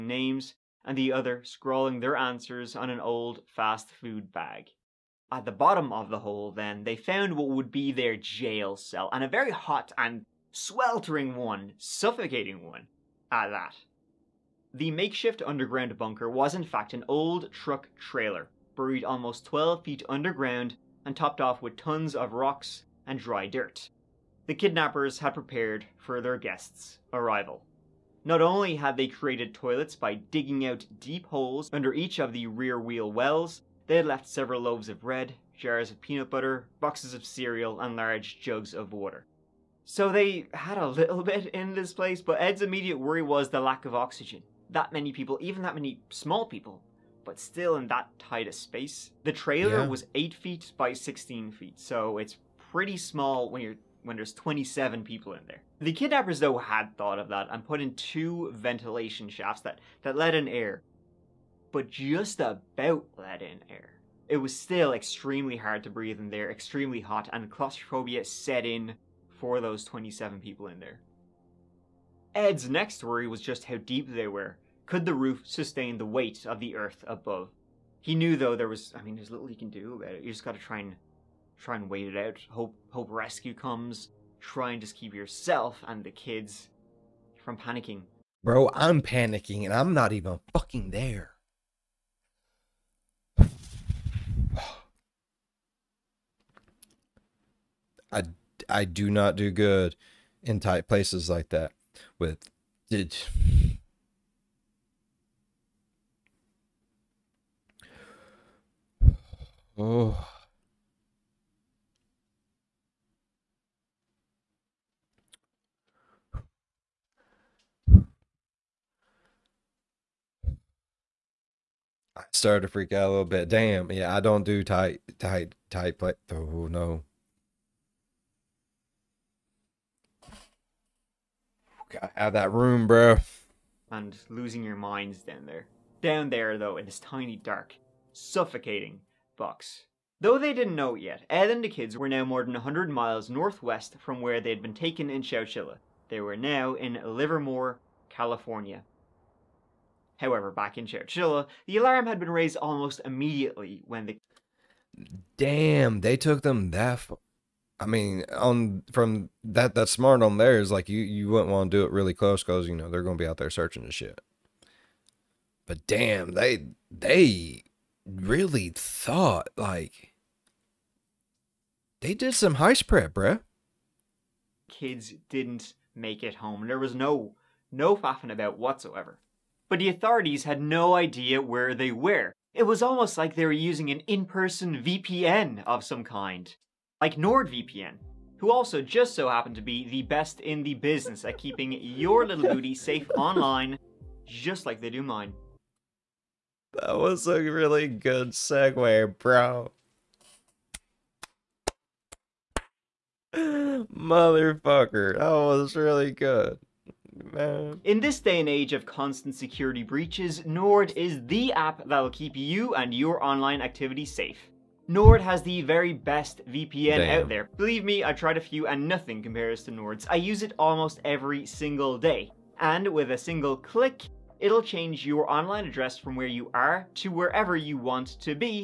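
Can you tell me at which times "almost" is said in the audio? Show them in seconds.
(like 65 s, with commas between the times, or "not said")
19 s, 152 s, 182 s, 220 s.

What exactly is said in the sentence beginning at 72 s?
Ed's next worry was just how deep they were.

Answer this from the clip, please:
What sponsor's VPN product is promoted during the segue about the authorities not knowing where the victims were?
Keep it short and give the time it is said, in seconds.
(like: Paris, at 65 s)
NordVPN, at 187 s.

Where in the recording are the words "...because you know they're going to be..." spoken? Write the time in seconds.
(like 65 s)
162 s.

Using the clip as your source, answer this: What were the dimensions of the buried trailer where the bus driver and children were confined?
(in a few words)
8 feet by 16 feet.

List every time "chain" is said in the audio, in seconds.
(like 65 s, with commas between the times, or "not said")
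not said.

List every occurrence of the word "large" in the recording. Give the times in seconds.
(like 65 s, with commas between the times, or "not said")
37 s.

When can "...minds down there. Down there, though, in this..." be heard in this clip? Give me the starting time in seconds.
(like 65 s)
134 s.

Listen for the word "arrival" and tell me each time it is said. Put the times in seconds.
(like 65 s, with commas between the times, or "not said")
27 s.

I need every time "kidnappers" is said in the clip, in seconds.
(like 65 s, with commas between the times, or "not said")
24 s, 55 s.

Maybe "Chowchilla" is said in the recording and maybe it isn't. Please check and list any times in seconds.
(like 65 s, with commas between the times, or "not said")
145 s, 150 s.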